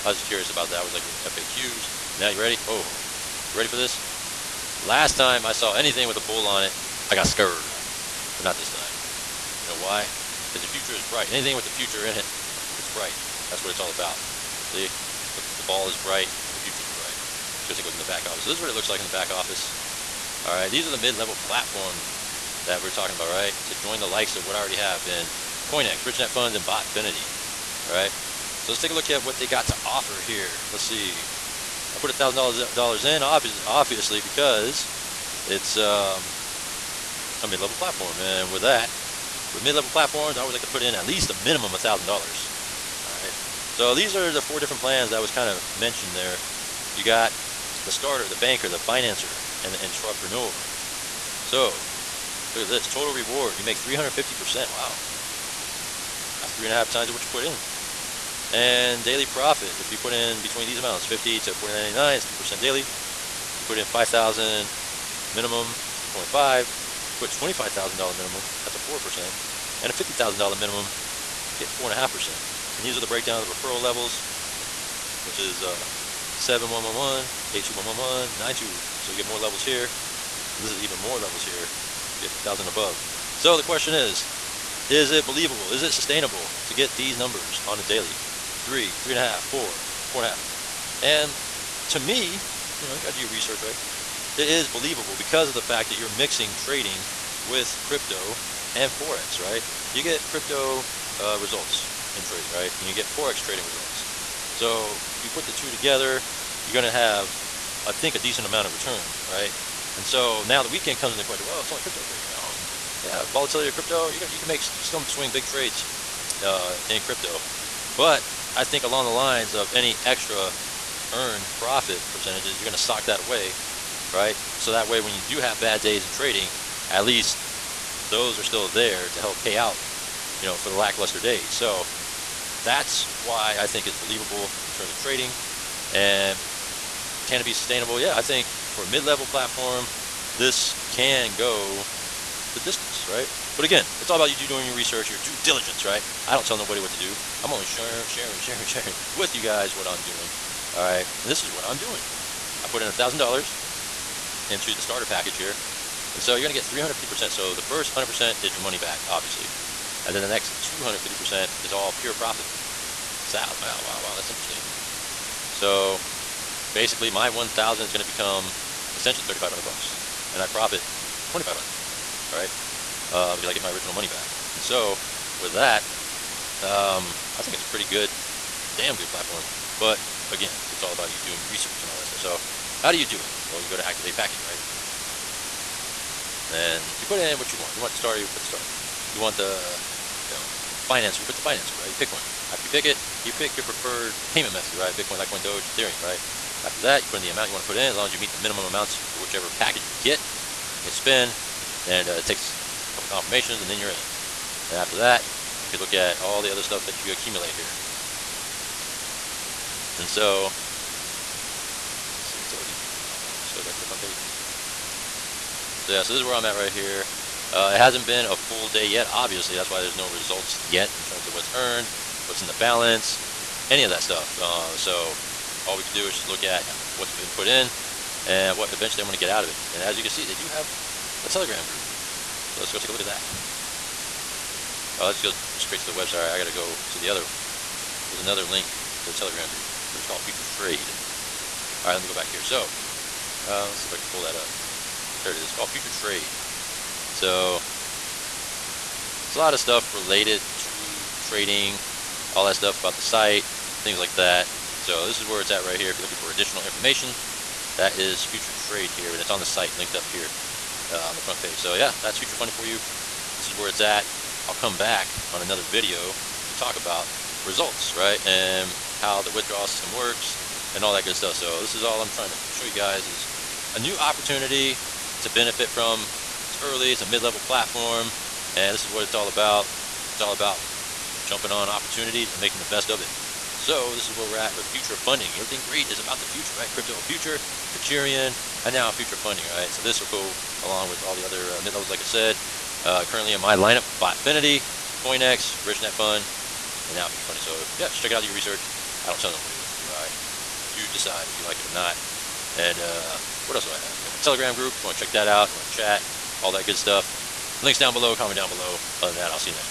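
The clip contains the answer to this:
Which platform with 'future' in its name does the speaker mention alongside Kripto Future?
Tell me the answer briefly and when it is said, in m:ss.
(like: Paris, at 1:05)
Futurion, at 4:47.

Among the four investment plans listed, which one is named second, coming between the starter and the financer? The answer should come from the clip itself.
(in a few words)
Banker.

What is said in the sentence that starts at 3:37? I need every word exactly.
Uh, it hasn't been a full day yet, obviously.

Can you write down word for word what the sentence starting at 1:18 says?
So you get more levels here.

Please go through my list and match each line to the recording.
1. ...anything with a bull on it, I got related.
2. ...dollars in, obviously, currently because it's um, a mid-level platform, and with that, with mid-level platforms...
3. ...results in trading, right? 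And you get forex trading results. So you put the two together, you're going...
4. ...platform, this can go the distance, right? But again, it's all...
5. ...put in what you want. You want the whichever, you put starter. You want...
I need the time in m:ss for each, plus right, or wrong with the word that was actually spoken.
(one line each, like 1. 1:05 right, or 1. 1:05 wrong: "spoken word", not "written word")
1. 0:05 wrong: "scared", not "related"
2. 0:32 wrong: "obviously", not "currently"
3. 1:41 right
4. 2:19 right
5. 3:07 wrong: "starter", not "whichever".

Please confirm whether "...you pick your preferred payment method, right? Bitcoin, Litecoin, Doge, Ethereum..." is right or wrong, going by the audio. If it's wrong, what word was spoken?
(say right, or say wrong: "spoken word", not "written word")
right.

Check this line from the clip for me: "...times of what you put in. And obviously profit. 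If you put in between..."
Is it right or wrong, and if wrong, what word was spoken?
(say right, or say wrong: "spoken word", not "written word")
wrong: "daily", not "obviously".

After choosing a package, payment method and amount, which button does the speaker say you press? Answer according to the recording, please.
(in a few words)
Spin.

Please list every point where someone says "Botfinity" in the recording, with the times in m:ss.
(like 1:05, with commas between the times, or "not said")
0:26, 4:53.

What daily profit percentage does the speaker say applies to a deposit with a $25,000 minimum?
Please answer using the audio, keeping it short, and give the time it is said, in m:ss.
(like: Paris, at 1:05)
4%, at 1:08.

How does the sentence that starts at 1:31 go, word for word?
And to me, you know, you got to do your research, right?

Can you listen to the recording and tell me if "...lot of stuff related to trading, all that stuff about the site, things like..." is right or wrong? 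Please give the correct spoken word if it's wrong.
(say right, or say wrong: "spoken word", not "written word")
right.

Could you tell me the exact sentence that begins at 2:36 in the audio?
And so you're going to get 350%.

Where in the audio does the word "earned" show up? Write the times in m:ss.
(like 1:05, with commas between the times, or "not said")
2:01, 3:41.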